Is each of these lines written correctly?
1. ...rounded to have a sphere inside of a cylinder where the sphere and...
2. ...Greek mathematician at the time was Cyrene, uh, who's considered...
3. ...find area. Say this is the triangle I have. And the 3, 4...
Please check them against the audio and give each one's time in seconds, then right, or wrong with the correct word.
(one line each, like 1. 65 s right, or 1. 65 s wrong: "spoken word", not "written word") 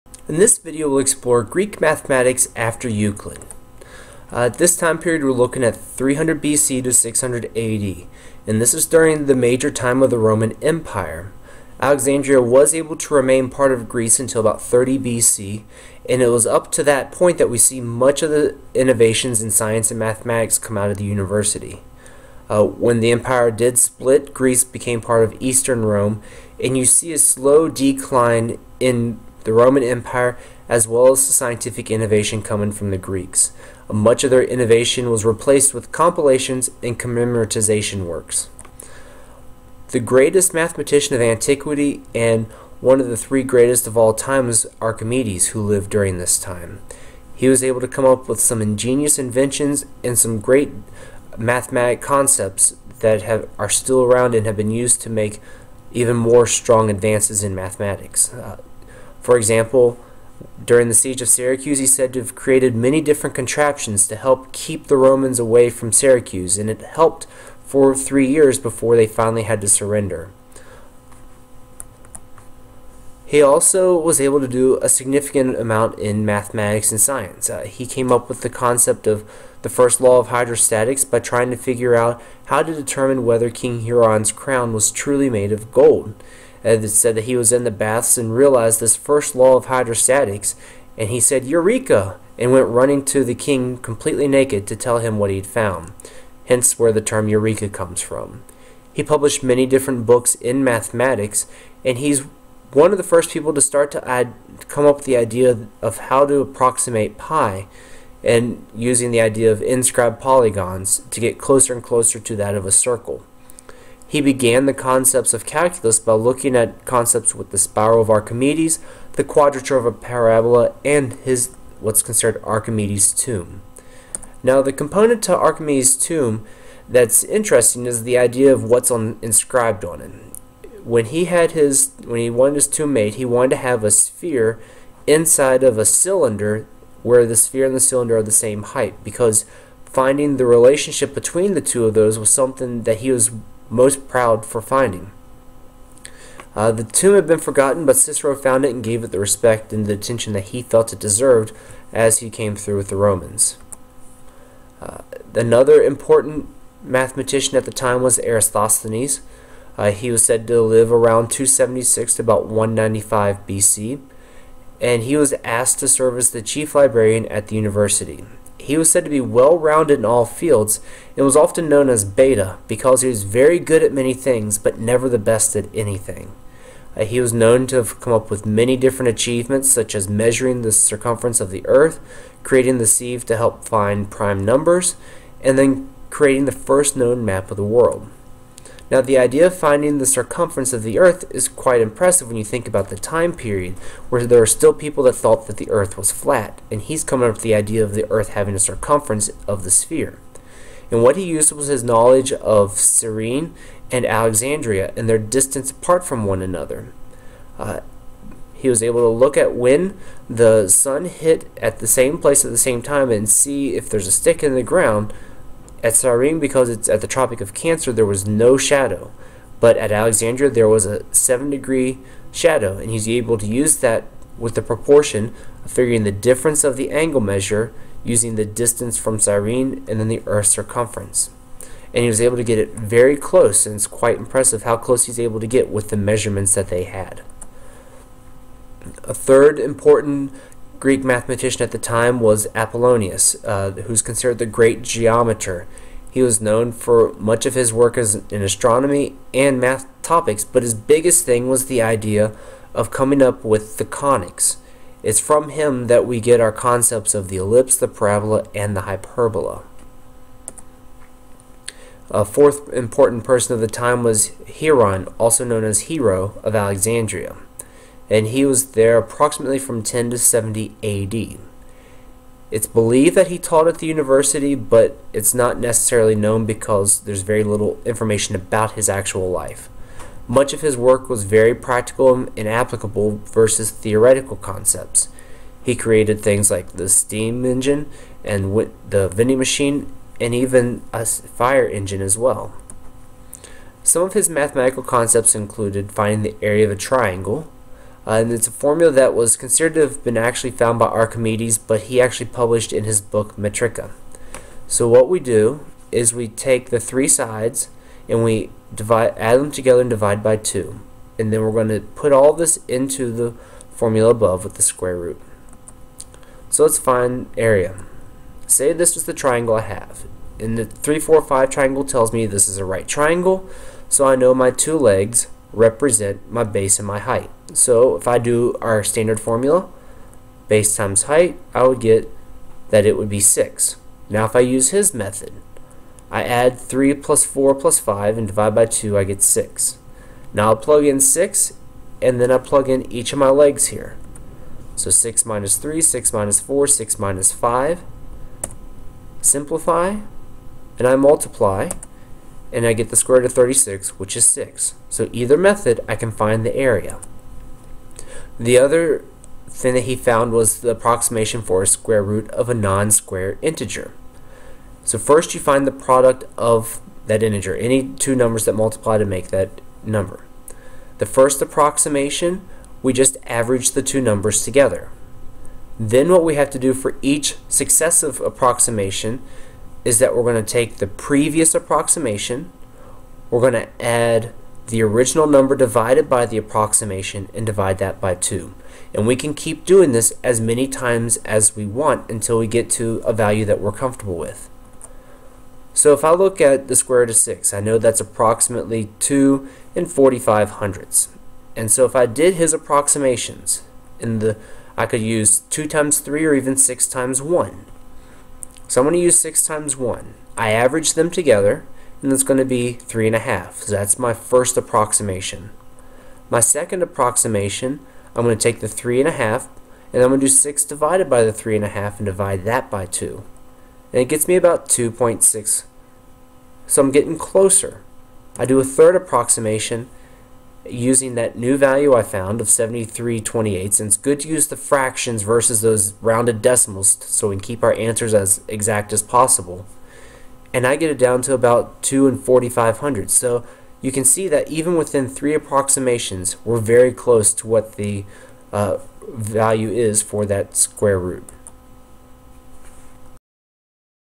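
1. 133 s wrong: "wanted", not "rounded"
2. 240 s wrong: "Apollonius", not "Cyrene"
3. 316 s right.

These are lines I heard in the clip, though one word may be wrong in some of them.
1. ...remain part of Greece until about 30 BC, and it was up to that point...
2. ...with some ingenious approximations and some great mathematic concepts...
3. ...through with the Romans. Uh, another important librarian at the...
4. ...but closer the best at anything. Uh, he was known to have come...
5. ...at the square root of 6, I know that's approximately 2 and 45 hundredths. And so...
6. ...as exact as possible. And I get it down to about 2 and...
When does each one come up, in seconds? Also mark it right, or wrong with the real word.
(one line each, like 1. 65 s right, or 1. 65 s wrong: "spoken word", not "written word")
1. 13 s right
2. 48 s wrong: "inventions", not "approximations"
3. 152 s wrong: "mathematician", not "librarian"
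4. 174 s wrong: "never", not "closer"
5. 396 s right
6. 438 s right.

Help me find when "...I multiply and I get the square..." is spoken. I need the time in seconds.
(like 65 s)
350 s.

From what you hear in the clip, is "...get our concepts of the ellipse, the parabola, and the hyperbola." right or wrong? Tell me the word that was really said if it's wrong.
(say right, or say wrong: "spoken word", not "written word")
right.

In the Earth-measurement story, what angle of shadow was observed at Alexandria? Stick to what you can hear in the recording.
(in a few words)
7 degrees.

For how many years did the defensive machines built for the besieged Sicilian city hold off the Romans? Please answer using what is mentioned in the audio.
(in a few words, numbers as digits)
3.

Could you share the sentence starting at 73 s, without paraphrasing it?
He also was able to do a significant amount in mathematics and science.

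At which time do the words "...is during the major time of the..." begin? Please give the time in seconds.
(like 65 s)
8 s.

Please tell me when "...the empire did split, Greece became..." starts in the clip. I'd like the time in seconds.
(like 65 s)
23 s.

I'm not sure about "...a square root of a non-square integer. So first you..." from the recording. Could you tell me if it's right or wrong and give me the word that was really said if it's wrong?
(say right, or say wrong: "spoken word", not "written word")
right.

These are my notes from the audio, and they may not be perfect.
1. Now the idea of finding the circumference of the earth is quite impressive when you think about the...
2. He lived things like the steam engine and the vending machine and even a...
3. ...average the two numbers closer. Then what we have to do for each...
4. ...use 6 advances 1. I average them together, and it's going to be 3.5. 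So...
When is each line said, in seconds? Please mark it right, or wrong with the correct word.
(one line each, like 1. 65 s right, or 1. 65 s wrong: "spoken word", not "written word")
1. 188 s right
2. 285 s wrong: "created", not "lived"
3. 373 s wrong: "together", not "closer"
4. 409 s wrong: "times", not "advances".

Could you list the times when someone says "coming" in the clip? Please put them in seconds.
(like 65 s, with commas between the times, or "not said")
32 s, 197 s, 252 s.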